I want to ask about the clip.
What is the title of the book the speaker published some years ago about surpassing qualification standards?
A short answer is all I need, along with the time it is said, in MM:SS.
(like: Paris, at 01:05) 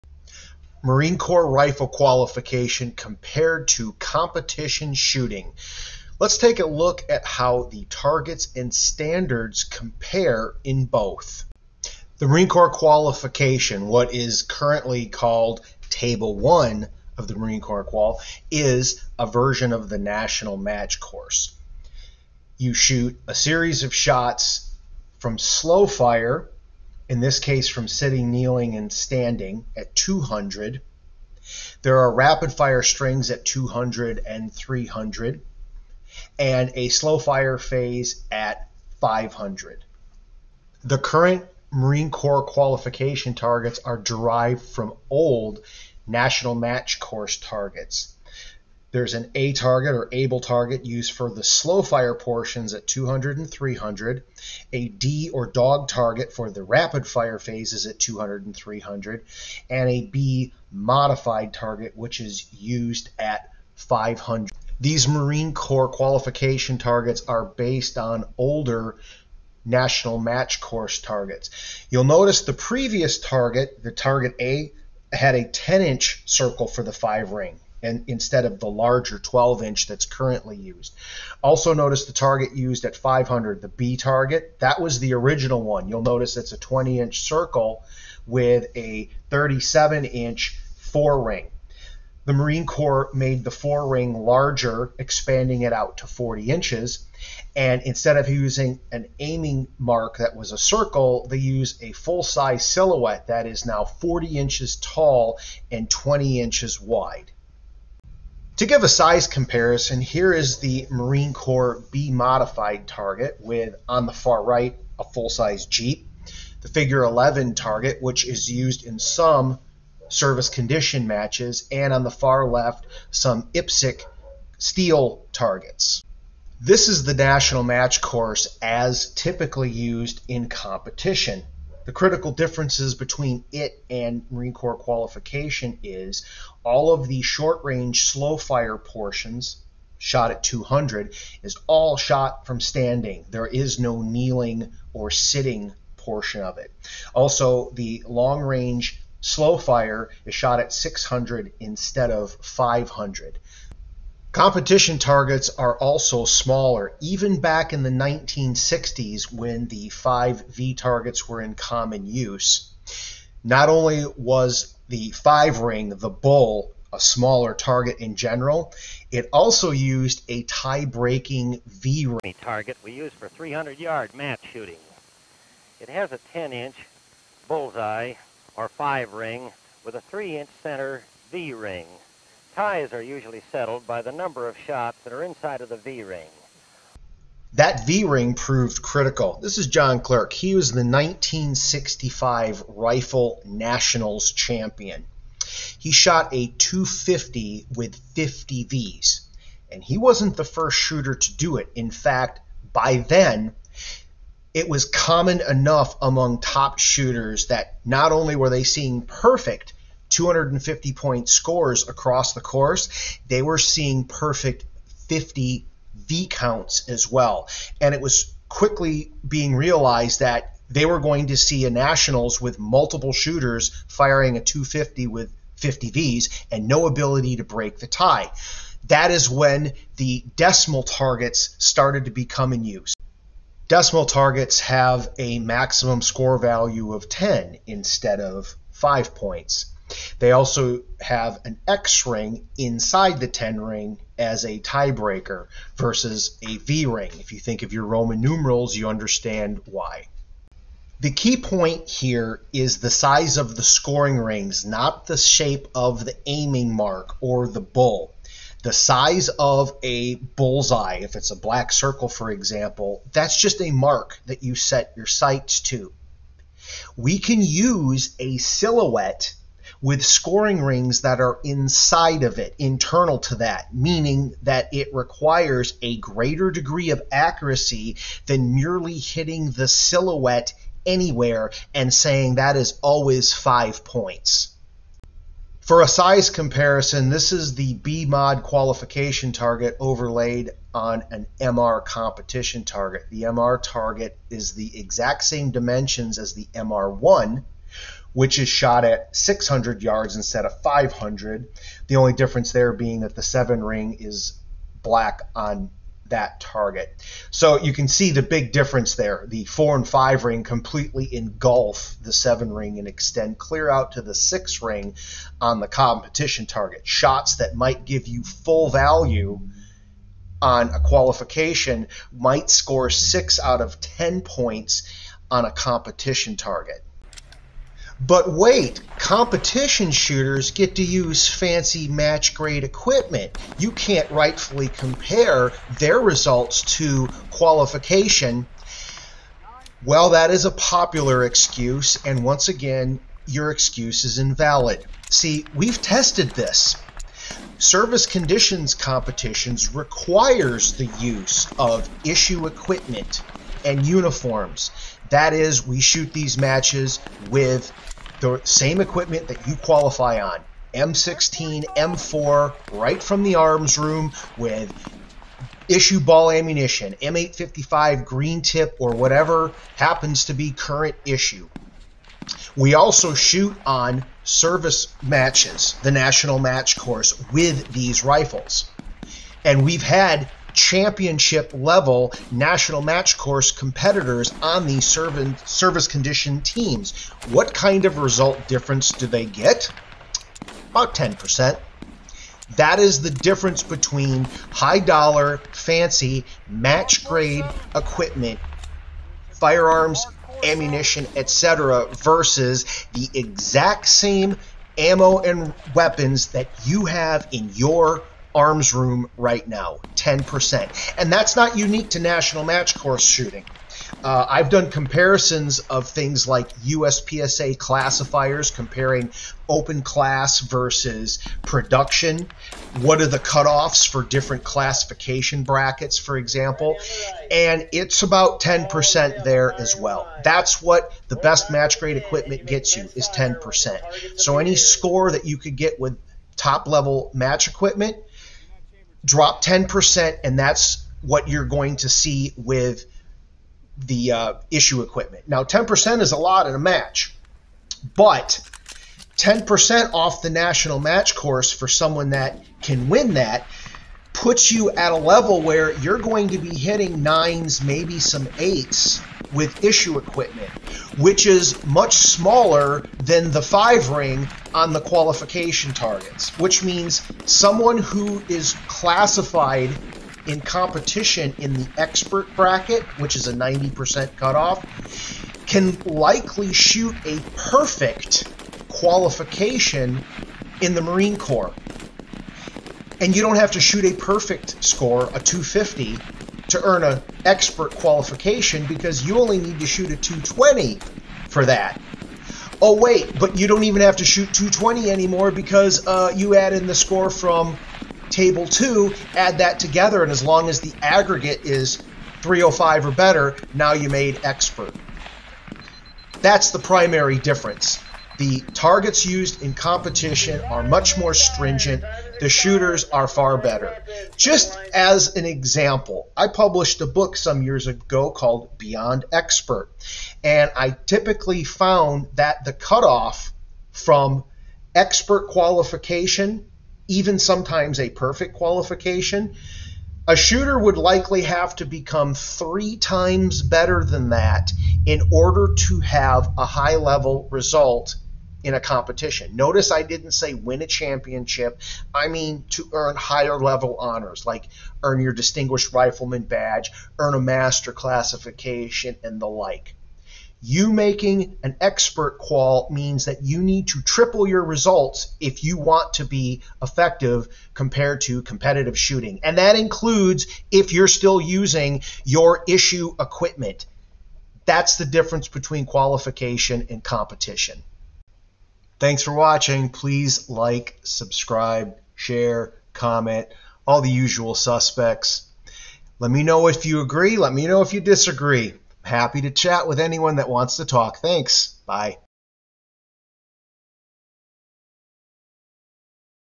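Beyond Expert, at 08:38.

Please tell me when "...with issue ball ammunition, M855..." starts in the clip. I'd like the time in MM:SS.
06:04.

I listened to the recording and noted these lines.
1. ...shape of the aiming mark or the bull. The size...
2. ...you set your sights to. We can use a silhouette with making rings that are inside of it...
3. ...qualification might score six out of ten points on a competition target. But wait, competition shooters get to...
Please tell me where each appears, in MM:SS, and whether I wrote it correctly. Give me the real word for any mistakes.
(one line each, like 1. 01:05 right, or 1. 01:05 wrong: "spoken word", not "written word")
1. 04:15 right
2. 04:24 wrong: "scoring", not "making"
3. 05:20 right.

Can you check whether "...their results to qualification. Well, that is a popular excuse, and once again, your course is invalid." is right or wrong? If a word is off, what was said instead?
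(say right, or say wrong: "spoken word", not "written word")
wrong: "excuse", not "course".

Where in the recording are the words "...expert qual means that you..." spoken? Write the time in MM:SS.
09:11.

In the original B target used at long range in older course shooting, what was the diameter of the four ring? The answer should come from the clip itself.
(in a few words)
37 inches.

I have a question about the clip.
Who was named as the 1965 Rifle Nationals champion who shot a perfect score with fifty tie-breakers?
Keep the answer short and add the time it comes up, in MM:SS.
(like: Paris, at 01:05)
John Clerk, at 03:09.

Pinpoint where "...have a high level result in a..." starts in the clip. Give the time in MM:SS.
08:55.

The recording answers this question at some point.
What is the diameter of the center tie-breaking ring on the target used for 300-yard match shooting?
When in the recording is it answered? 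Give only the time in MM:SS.
03:00.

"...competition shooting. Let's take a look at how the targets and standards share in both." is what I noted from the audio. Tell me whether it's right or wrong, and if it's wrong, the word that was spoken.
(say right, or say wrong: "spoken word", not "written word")
wrong: "compare", not "share".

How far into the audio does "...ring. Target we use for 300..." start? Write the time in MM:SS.
02:52.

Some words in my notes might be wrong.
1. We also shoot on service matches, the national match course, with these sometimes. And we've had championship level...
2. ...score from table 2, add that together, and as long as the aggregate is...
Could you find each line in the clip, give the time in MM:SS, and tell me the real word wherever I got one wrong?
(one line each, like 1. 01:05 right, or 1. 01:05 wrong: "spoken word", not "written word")
1. 06:12 wrong: "rifles", not "sometimes"
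2. 08:16 right.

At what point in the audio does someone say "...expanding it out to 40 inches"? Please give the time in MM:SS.
01:34.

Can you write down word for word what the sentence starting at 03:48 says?
That is when the decimal targets started to become in use.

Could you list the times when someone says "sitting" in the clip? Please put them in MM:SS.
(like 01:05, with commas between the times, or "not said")
00:27, 02:25.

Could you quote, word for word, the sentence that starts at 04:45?
For a size comparison, this is the B mod qualification target overlaid on an MR competition target.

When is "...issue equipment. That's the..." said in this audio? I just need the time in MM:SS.
09:22.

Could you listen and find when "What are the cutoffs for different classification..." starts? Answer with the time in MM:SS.
07:02.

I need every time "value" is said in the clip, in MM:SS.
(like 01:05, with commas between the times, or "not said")
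03:56, 05:18.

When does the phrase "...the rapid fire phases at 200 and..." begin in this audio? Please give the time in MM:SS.
00:56.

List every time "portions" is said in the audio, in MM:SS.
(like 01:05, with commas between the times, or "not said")
00:52, 02:18, 02:25.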